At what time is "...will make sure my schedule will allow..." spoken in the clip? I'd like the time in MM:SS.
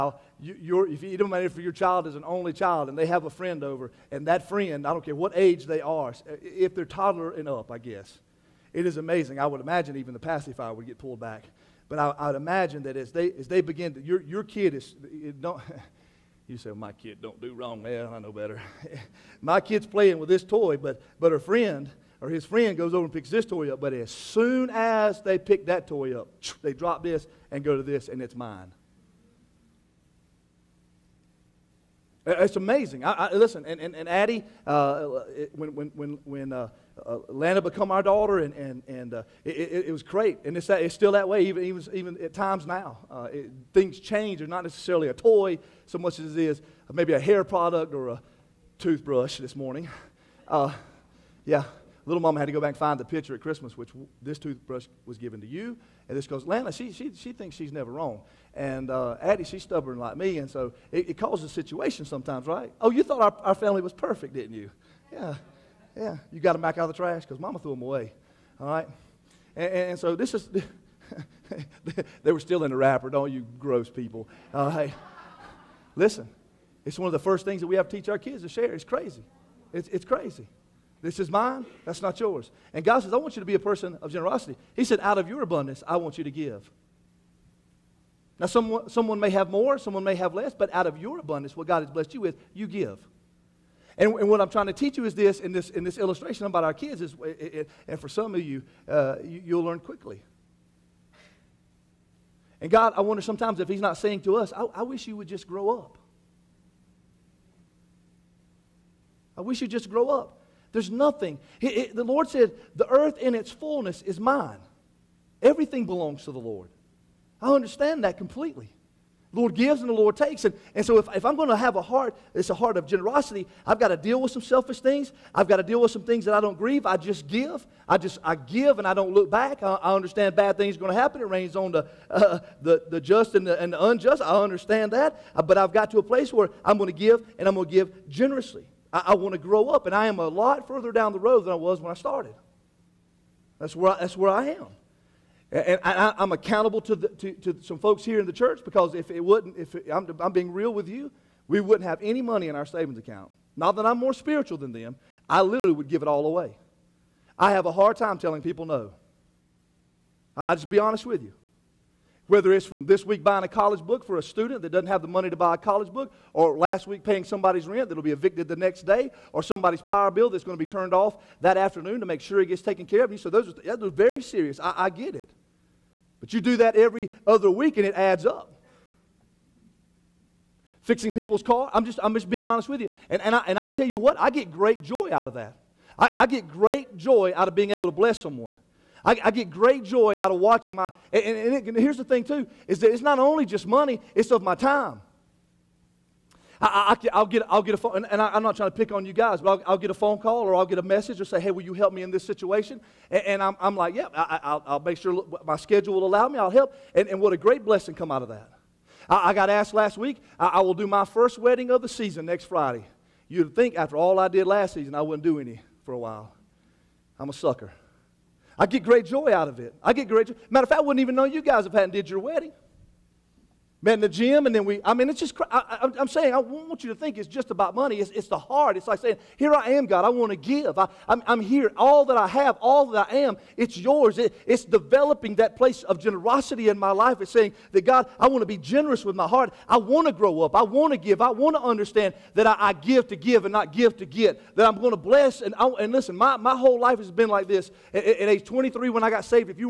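03:24.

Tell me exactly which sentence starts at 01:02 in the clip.
Oh, you thought our, our family was perfect, didn't you?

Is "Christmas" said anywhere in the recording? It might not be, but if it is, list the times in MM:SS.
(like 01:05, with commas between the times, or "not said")
00:53.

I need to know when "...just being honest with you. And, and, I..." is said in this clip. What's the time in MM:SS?
03:02.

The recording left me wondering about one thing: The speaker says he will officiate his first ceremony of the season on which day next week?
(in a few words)
Friday.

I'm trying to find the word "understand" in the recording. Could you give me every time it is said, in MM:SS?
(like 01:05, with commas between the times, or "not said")
01:57, 02:09, 02:14, 04:01.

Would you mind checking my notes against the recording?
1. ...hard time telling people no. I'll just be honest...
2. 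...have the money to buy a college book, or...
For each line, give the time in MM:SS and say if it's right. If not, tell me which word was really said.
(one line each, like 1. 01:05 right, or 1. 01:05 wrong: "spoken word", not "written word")
1. 02:37 right
2. 02:44 right.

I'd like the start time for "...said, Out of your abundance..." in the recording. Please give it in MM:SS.
01:24.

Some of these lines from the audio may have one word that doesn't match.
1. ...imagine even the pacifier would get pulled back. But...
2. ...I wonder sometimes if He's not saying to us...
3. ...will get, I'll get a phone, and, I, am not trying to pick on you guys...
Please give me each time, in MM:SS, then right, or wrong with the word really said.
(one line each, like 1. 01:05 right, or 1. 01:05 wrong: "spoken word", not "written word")
1. 00:09 right
2. 01:42 right
3. 03:17 right.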